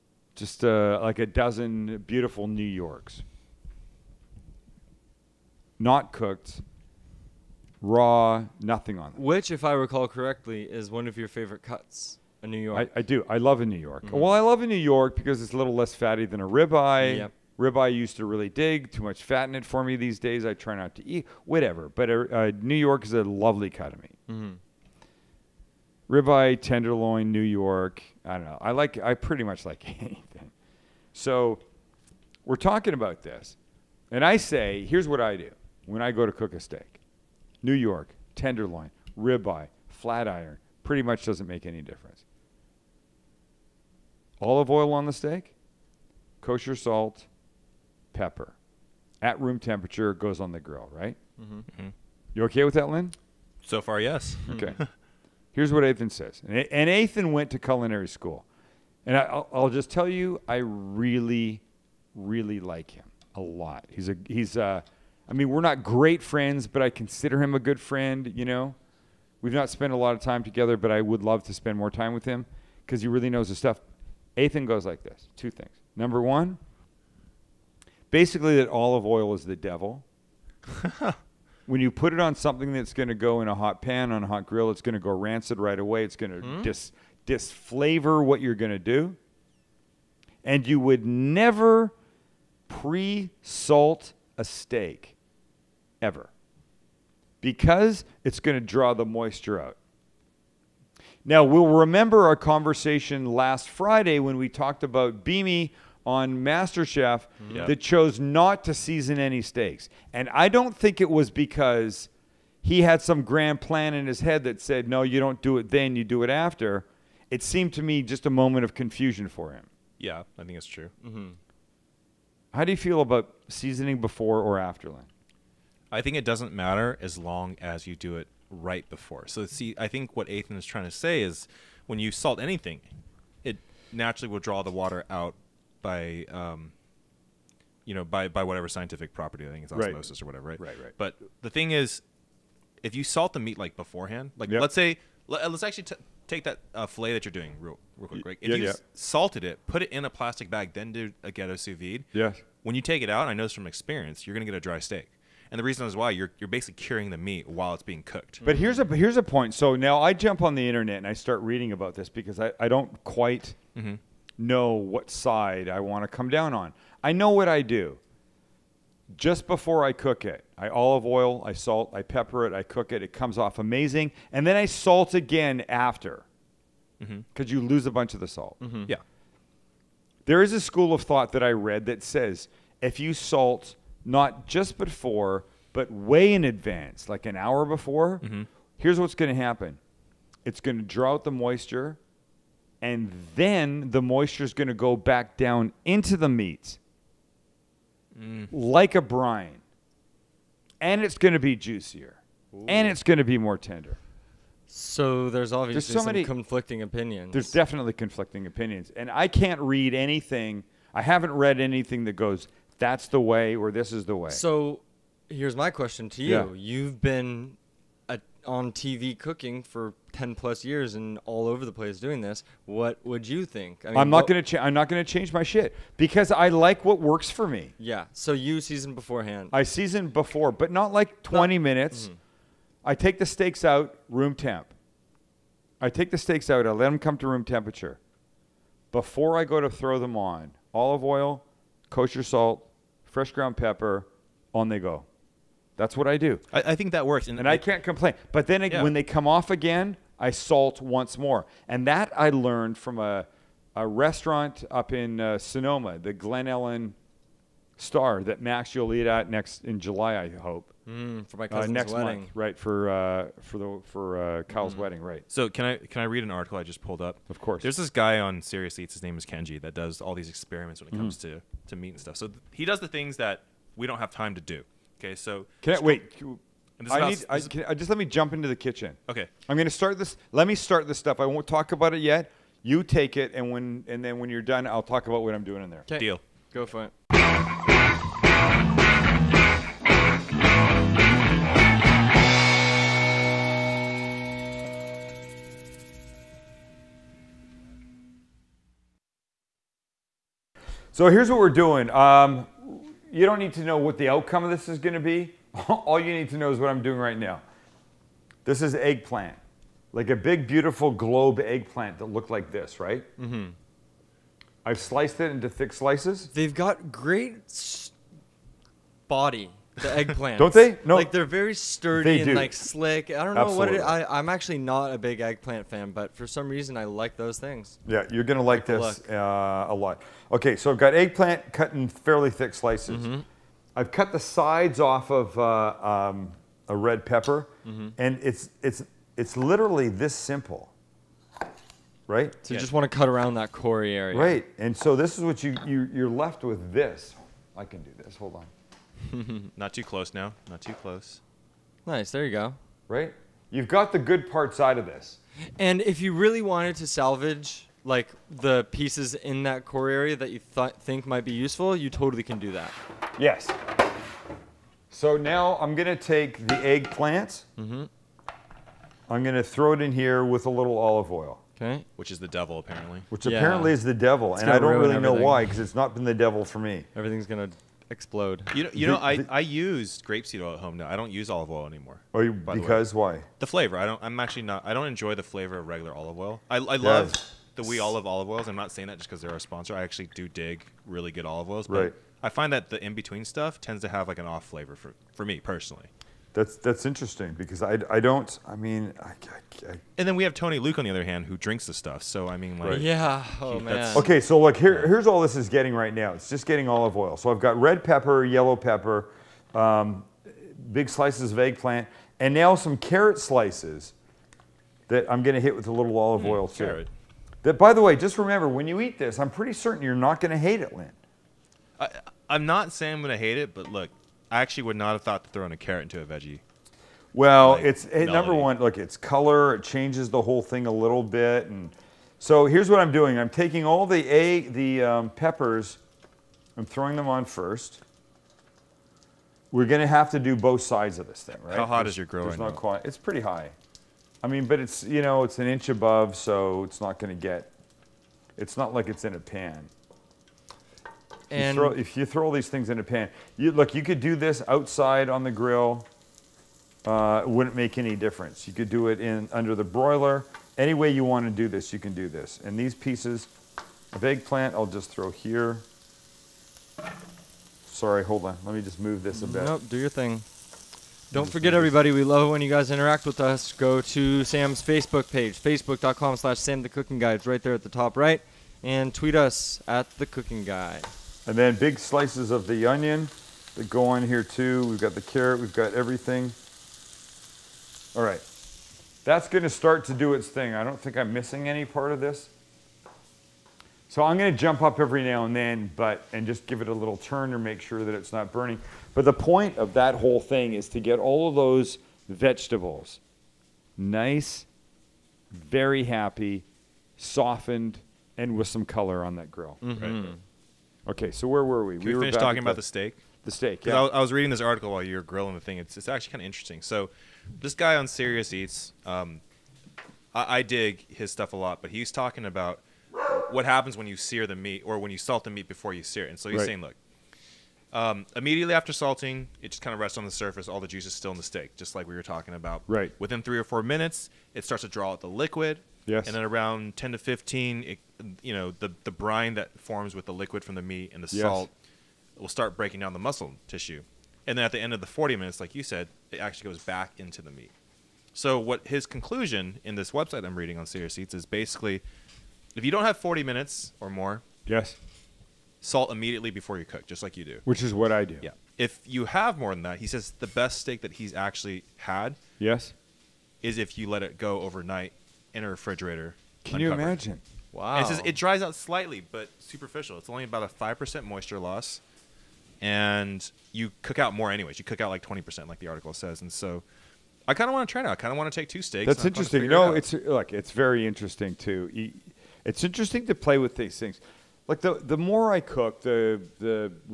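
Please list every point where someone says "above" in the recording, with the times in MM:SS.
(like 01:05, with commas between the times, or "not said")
07:25.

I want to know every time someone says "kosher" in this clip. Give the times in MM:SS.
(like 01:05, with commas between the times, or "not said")
00:46, 04:01.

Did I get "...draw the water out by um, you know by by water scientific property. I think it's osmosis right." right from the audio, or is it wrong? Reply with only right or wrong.
wrong.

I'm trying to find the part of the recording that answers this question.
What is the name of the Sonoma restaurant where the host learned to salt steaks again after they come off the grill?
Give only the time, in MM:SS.
04:15.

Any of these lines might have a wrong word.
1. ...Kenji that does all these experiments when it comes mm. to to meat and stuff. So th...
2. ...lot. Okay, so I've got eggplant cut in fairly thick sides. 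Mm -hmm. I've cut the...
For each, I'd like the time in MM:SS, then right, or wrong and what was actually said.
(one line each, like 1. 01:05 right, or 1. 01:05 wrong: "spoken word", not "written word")
1. 04:29 right
2. 05:29 wrong: "slices", not "sides".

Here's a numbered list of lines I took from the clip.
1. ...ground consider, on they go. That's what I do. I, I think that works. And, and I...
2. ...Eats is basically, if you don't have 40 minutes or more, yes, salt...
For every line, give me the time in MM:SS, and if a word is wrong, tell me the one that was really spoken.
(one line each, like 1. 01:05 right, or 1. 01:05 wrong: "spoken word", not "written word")
1. 04:03 wrong: "pepper", not "consider"
2. 09:10 right.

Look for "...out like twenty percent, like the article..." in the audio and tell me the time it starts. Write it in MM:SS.
09:34.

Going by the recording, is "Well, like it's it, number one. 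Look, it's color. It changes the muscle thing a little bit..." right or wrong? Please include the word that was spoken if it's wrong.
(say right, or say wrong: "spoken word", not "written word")
wrong: "whole", not "muscle".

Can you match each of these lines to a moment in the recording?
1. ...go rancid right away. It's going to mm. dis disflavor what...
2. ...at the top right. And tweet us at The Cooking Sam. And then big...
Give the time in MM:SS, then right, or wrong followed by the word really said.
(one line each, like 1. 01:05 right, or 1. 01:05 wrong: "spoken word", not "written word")
1. 01:24 right
2. 07:57 wrong: "Guy", not "Sam".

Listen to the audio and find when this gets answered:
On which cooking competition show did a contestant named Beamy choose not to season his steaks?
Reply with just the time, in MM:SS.
01:46.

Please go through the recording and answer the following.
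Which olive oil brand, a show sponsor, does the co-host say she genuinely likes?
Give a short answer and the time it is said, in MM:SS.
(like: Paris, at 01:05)
We Olive, at 06:27.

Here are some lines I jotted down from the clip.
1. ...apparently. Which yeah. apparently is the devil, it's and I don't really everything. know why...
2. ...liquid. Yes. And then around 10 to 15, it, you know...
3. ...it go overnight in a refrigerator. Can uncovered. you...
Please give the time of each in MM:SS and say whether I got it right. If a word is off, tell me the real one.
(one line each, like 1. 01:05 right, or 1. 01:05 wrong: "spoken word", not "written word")
1. 06:12 right
2. 08:55 right
3. 09:24 right.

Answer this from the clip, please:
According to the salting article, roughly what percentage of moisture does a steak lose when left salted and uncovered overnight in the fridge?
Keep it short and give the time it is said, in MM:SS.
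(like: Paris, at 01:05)
5 percent, at 09:30.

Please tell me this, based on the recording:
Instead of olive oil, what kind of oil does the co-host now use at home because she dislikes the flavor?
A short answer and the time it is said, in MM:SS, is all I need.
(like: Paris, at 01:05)
grapeseed oil, at 06:19.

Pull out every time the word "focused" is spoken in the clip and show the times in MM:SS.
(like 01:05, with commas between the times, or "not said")
not said.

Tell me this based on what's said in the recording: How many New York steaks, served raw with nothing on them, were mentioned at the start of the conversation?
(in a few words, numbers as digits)
a dozen.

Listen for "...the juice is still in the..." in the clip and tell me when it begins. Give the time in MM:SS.
08:50.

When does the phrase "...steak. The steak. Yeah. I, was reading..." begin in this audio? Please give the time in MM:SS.
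08:32.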